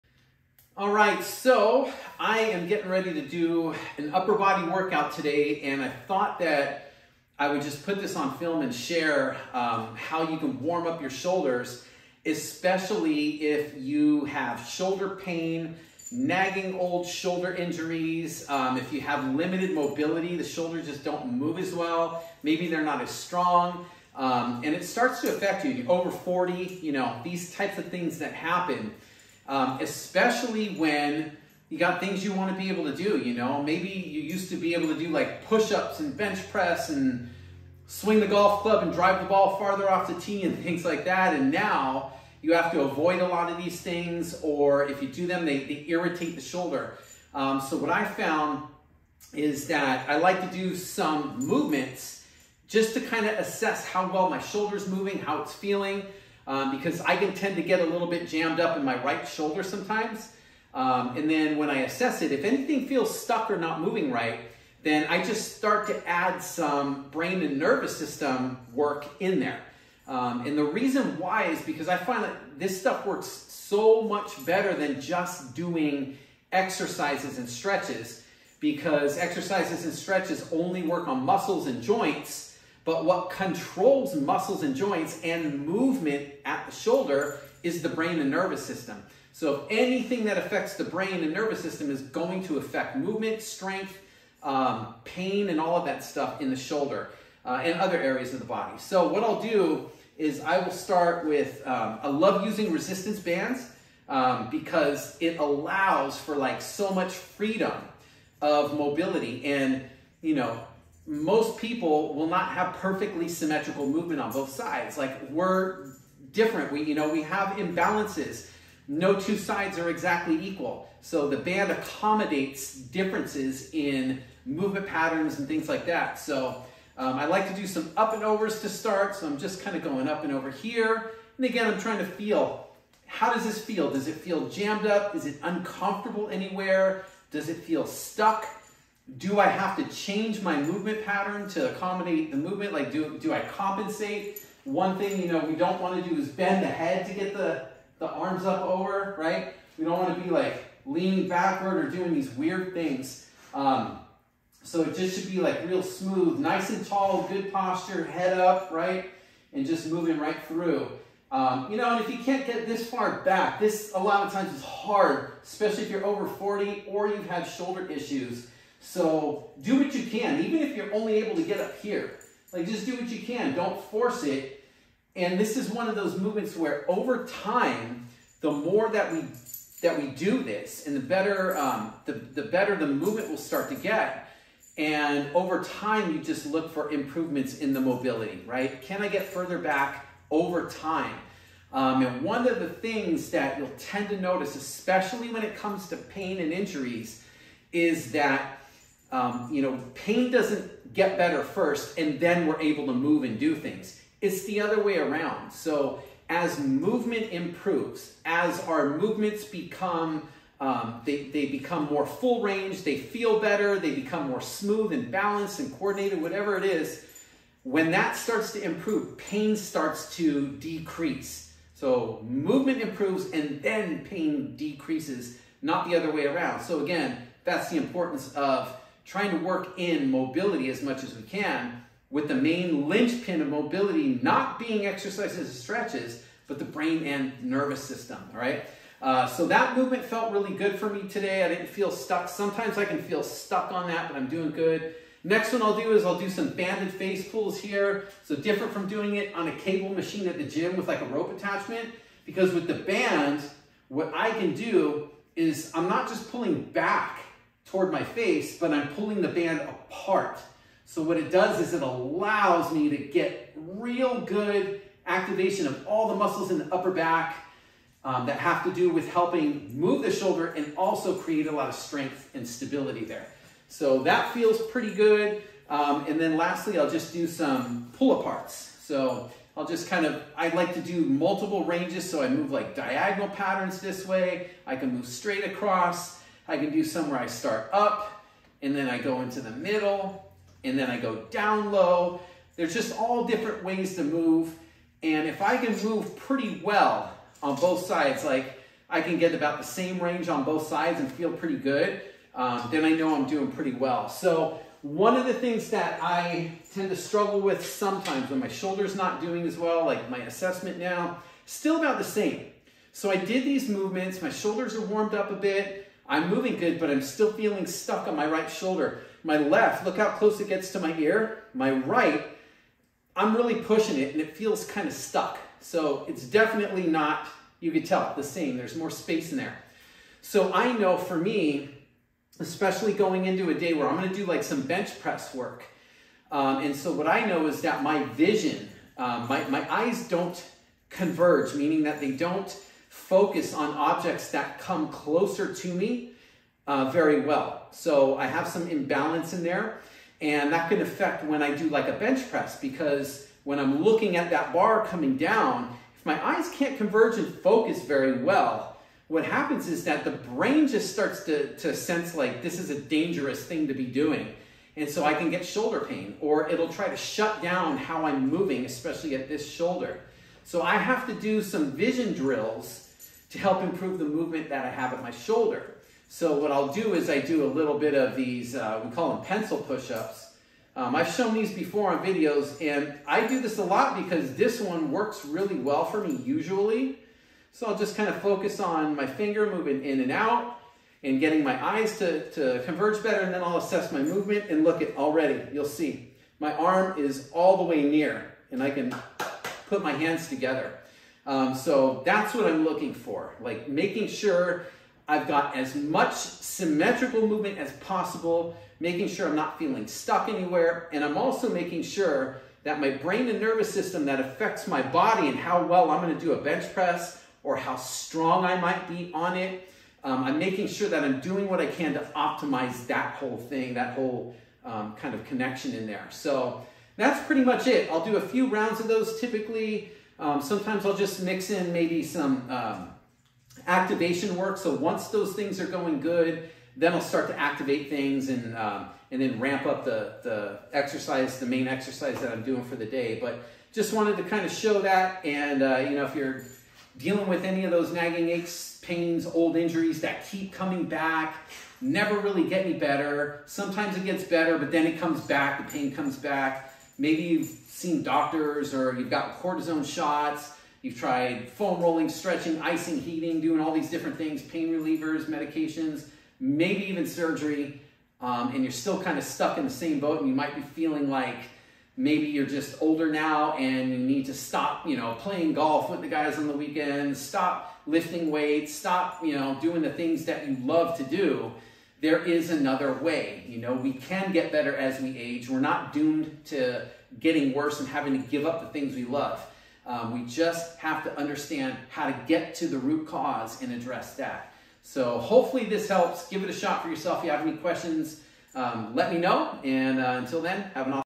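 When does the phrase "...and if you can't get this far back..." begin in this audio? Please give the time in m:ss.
2:41.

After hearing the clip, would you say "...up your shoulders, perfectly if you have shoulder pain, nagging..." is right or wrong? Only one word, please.
wrong.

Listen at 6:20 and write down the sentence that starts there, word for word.
Um, I've shown these before on videos, and I do this a lot because this one works really well for me usually.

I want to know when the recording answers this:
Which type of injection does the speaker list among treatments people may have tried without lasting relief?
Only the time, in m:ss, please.
7:39.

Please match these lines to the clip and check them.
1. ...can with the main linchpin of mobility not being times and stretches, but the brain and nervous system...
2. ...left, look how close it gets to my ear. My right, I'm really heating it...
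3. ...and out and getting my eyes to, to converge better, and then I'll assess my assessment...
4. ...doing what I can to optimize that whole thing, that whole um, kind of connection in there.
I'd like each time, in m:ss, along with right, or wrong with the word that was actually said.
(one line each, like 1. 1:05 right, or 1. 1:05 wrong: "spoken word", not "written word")
1. 3:51 wrong: "exercises", not "times"
2. 5:19 wrong: "pushing", not "heating"
3. 6:30 wrong: "movement", not "assessment"
4. 7:01 right.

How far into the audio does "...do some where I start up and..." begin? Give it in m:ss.
4:46.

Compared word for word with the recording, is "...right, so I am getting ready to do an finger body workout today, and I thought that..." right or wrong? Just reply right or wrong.
wrong.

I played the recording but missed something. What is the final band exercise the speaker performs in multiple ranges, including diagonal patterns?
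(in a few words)
pull aparts.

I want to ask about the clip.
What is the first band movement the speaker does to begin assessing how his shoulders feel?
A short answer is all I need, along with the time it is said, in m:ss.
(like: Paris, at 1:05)
up and overs, at 2:07.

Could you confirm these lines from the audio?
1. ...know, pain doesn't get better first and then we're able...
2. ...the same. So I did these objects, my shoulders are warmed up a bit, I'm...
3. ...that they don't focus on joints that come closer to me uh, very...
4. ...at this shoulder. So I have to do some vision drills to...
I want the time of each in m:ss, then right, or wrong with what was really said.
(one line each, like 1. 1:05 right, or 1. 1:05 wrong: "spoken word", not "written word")
1. 3:19 right
2. 5:11 wrong: "movements", not "objects"
3. 5:41 wrong: "objects", not "joints"
4. 6:09 right.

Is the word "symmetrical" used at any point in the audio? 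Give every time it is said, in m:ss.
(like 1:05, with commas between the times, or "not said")
1:53, 6:46.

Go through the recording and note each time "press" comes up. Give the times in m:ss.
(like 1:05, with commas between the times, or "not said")
0:36, 5:34, 5:52, 6:56.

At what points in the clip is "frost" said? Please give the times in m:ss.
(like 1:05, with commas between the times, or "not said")
not said.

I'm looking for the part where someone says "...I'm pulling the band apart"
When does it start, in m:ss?
4:18.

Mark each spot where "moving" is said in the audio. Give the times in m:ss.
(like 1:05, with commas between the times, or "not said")
0:54, 1:03, 2:39, 5:16, 6:08, 6:29.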